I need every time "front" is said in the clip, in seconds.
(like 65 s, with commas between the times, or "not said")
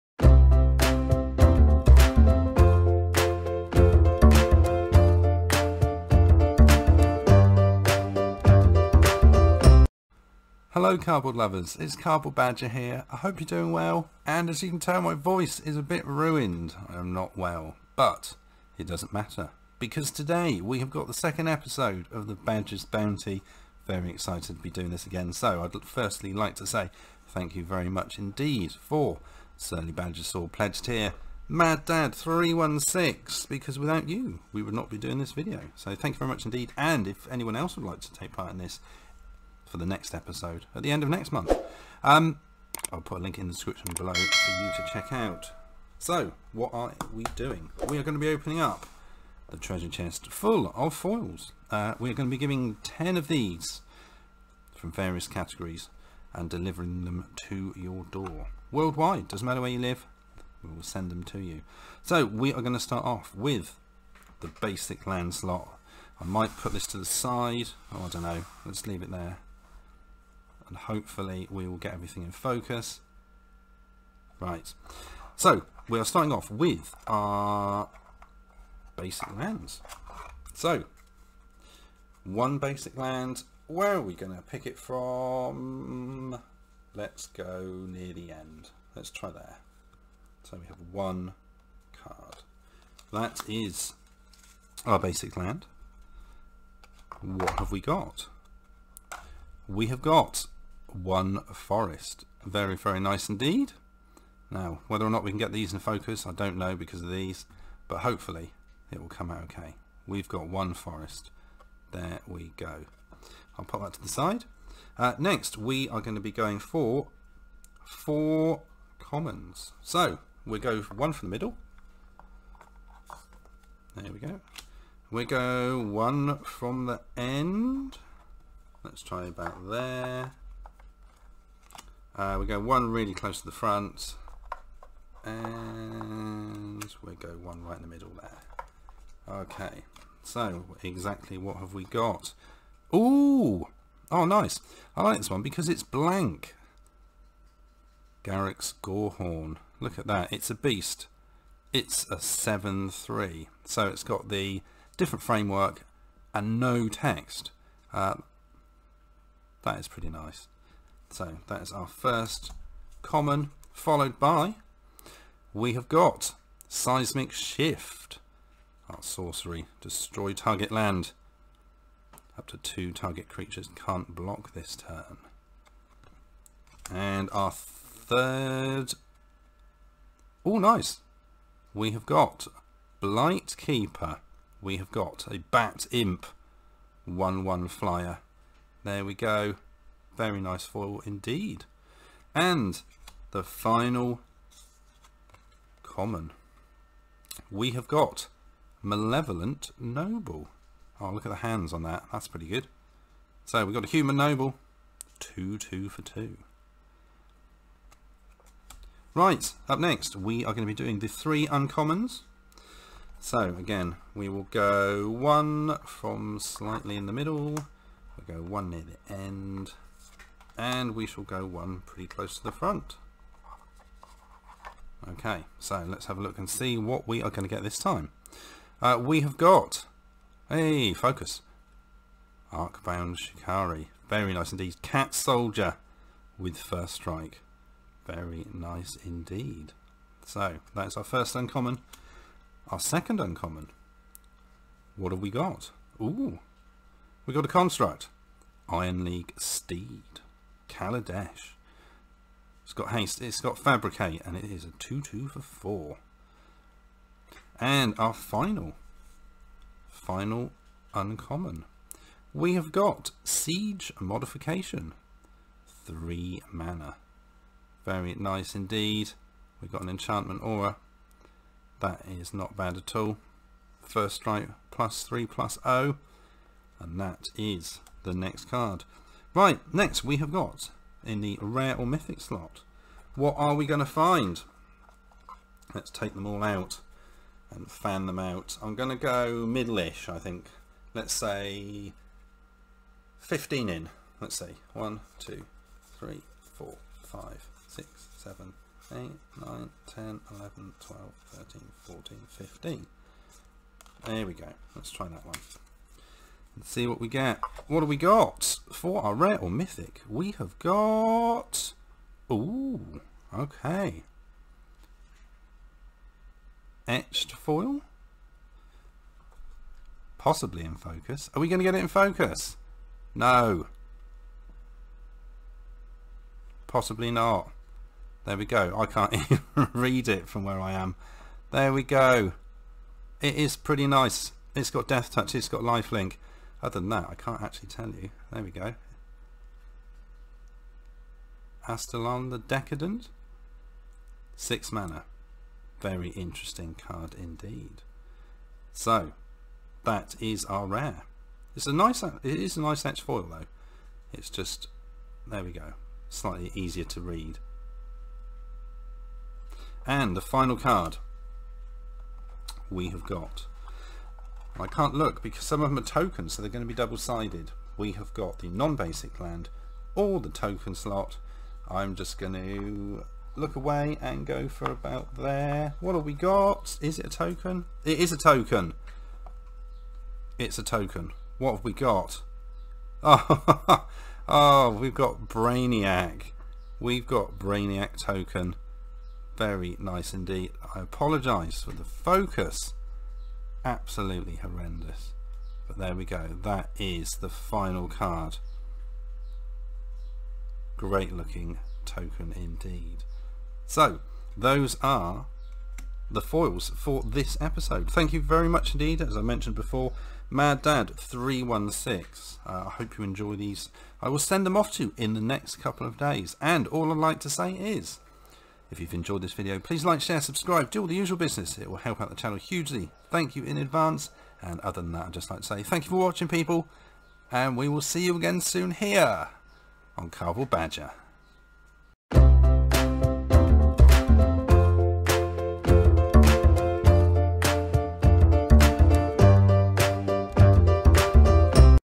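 133 s, 222 s.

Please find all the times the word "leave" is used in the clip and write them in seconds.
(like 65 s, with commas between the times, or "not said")
68 s.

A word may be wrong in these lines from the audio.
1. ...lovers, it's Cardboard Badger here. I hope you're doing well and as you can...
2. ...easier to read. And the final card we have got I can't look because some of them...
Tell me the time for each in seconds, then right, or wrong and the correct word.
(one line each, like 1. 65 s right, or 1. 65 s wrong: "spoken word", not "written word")
1. 11 s right
2. 356 s right.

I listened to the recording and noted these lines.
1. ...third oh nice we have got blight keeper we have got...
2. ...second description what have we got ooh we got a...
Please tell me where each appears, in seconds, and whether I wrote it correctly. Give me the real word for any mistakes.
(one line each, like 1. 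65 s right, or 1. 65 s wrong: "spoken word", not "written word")
1. 177 s right
2. 242 s wrong: "uncommon", not "description".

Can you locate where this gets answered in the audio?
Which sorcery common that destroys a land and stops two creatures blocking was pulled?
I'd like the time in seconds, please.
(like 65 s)
166 s.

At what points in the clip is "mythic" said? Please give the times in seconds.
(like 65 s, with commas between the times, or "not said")
281 s, 309 s.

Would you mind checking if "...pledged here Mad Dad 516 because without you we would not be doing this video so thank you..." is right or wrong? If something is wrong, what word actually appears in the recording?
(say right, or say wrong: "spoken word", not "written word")
wrong: "316", not "516".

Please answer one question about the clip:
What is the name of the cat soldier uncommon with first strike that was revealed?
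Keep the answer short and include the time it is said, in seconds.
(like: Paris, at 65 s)
Arcbound Shikari, at 232 s.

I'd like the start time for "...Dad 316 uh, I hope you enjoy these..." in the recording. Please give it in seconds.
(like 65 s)
410 s.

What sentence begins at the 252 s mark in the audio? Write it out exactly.
It's got haste, it's got fabricate, and it is a 2-2 for 4.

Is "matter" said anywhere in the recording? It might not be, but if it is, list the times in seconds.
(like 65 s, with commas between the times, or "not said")
19 s, 59 s.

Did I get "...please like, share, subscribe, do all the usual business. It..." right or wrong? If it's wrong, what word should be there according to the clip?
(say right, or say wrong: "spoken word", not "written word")
right.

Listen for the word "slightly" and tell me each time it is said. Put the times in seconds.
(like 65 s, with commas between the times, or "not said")
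216 s, 356 s.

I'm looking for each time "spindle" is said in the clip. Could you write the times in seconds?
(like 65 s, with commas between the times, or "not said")
not said.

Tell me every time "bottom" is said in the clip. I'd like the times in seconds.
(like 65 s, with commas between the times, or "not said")
not said.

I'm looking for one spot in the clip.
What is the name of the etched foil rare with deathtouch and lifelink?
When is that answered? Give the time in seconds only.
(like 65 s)
341 s.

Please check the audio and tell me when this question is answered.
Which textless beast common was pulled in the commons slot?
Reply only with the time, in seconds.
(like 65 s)
148 s.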